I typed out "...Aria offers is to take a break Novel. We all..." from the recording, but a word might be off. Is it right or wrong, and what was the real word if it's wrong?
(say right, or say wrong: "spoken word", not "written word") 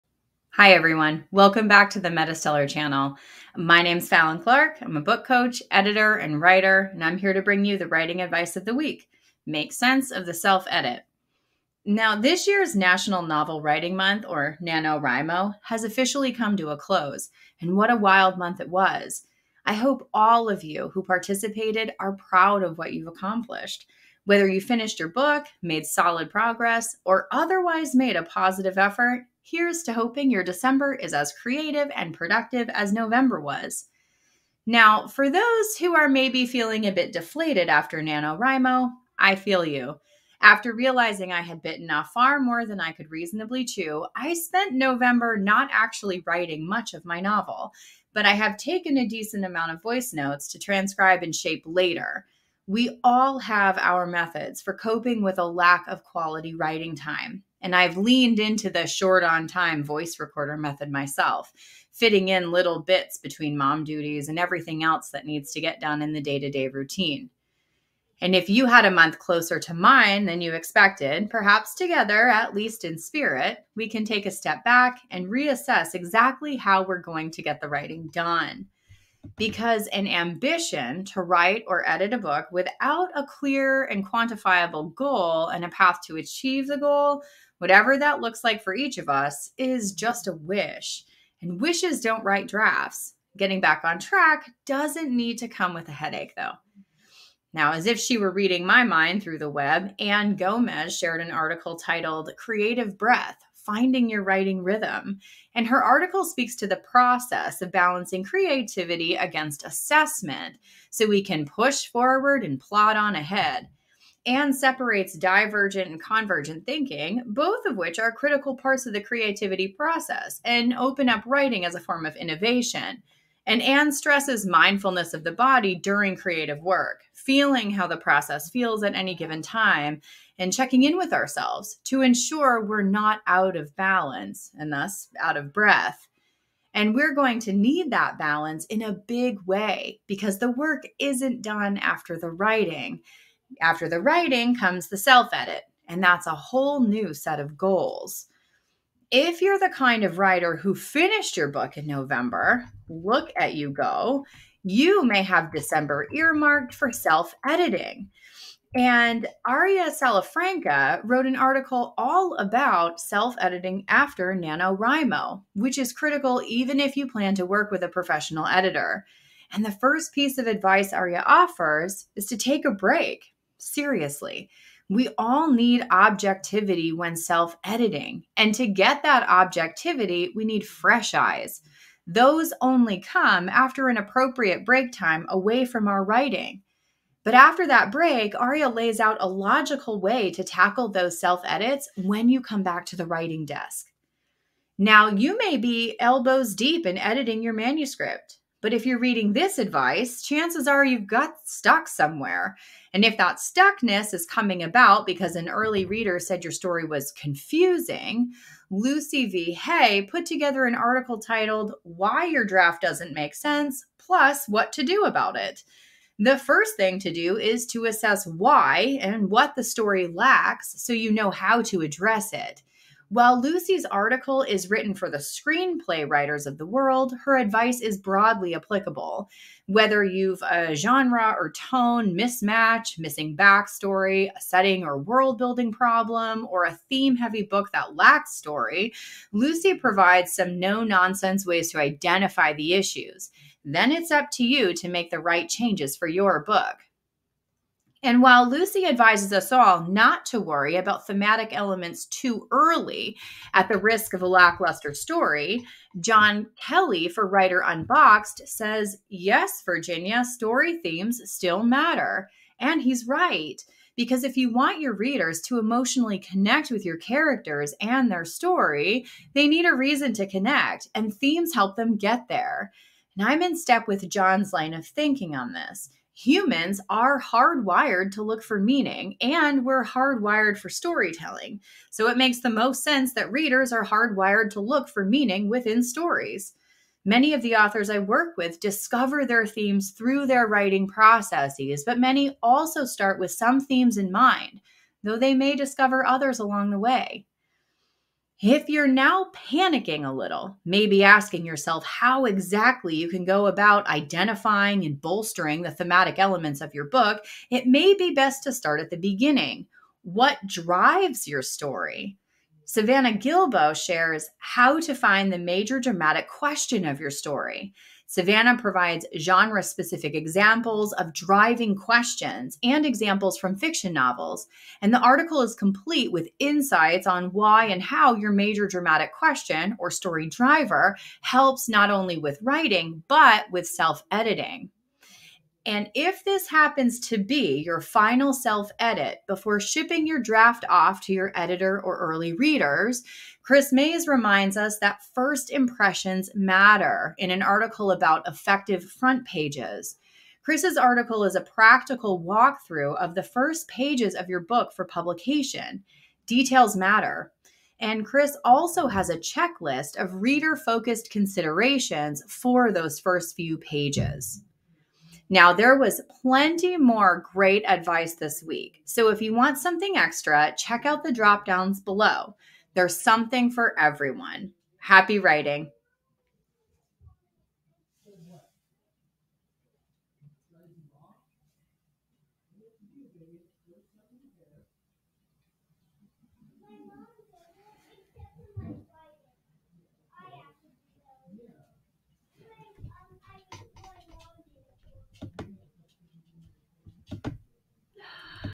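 wrong: "Seriously", not "Novel".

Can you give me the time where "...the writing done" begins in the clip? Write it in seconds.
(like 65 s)
77 s.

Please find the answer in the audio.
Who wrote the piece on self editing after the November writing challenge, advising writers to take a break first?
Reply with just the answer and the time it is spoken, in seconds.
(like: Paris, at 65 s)
Aria Salafranca, at 159 s.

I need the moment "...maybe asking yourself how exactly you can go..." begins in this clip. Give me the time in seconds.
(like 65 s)
300 s.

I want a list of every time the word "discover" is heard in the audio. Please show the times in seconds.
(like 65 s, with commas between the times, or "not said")
288 s, 295 s.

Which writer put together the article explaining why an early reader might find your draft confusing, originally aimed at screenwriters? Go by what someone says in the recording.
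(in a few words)
Lucy V. Hay.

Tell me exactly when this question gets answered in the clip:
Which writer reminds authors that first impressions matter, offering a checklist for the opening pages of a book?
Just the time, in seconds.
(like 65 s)
343 s.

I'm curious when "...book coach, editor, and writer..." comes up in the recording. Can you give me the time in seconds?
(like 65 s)
5 s.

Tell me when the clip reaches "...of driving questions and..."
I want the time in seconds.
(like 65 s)
320 s.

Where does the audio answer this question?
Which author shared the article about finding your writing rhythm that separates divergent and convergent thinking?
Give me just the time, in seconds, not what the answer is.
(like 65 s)
99 s.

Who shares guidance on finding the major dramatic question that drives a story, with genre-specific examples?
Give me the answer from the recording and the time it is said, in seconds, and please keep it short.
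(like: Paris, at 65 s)
Savannah Gilbo, at 312 s.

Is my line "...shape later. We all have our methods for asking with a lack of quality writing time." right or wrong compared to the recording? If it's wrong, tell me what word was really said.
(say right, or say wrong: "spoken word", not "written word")
wrong: "coping", not "asking".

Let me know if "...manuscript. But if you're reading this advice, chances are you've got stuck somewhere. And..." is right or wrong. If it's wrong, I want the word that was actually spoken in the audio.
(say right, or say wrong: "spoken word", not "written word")
right.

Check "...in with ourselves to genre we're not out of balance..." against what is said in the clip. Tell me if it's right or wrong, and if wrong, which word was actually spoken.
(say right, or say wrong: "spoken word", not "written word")
wrong: "ensure", not "genre".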